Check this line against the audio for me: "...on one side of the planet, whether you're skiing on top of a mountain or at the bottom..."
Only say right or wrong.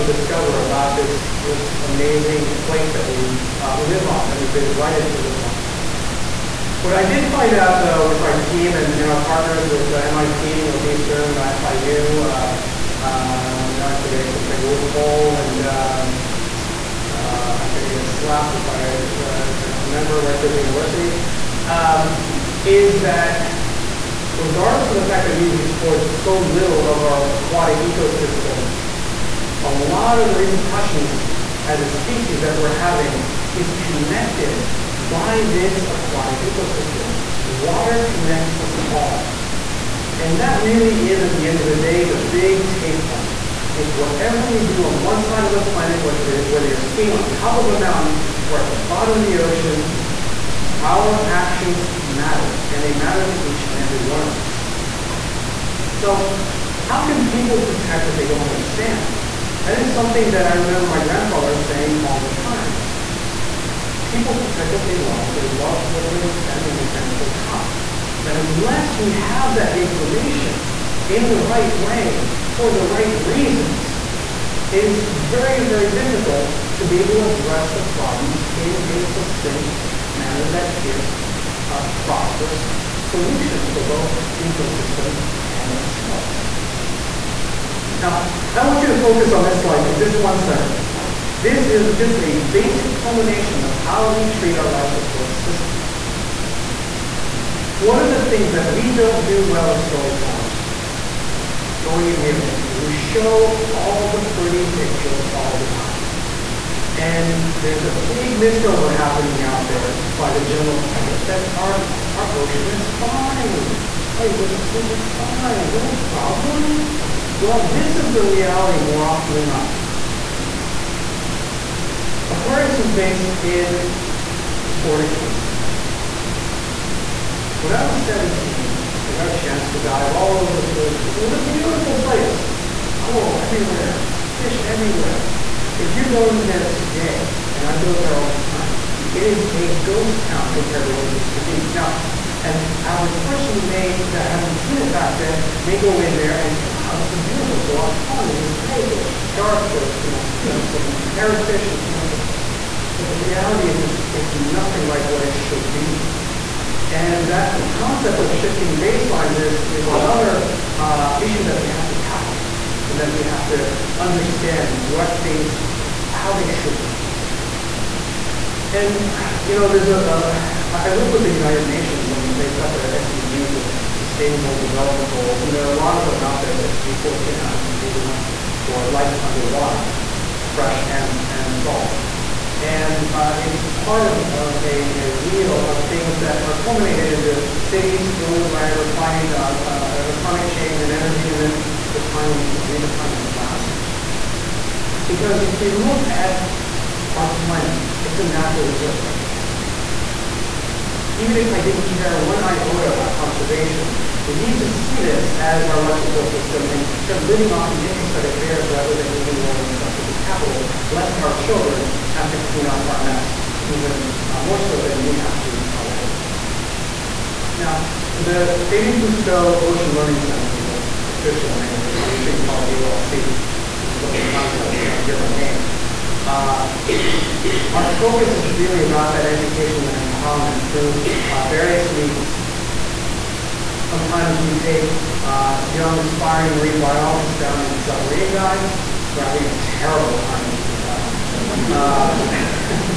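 right.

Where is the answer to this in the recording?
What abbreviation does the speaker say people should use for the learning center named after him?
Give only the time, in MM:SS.
03:42.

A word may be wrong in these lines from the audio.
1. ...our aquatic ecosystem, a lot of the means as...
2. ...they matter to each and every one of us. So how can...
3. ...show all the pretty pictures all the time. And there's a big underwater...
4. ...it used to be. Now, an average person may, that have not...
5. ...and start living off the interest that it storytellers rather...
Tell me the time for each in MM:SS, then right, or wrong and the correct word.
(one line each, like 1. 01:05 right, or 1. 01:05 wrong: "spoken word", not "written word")
1. 00:27 wrong: "repercussions", not "means"
2. 00:52 right
3. 01:42 wrong: "misnomer", not "underwater"
4. 02:21 right
5. 03:26 wrong: "bears", not "storytellers".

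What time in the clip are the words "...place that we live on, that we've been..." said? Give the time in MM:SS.
00:02.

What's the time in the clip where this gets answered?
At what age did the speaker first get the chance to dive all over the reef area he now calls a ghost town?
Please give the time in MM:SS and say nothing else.
02:08.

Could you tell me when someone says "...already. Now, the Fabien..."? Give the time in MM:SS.
03:35.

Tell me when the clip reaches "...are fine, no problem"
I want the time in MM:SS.
01:54.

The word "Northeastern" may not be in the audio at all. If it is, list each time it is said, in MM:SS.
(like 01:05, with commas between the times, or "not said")
00:10.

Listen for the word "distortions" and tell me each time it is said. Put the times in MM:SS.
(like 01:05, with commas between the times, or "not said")
not said.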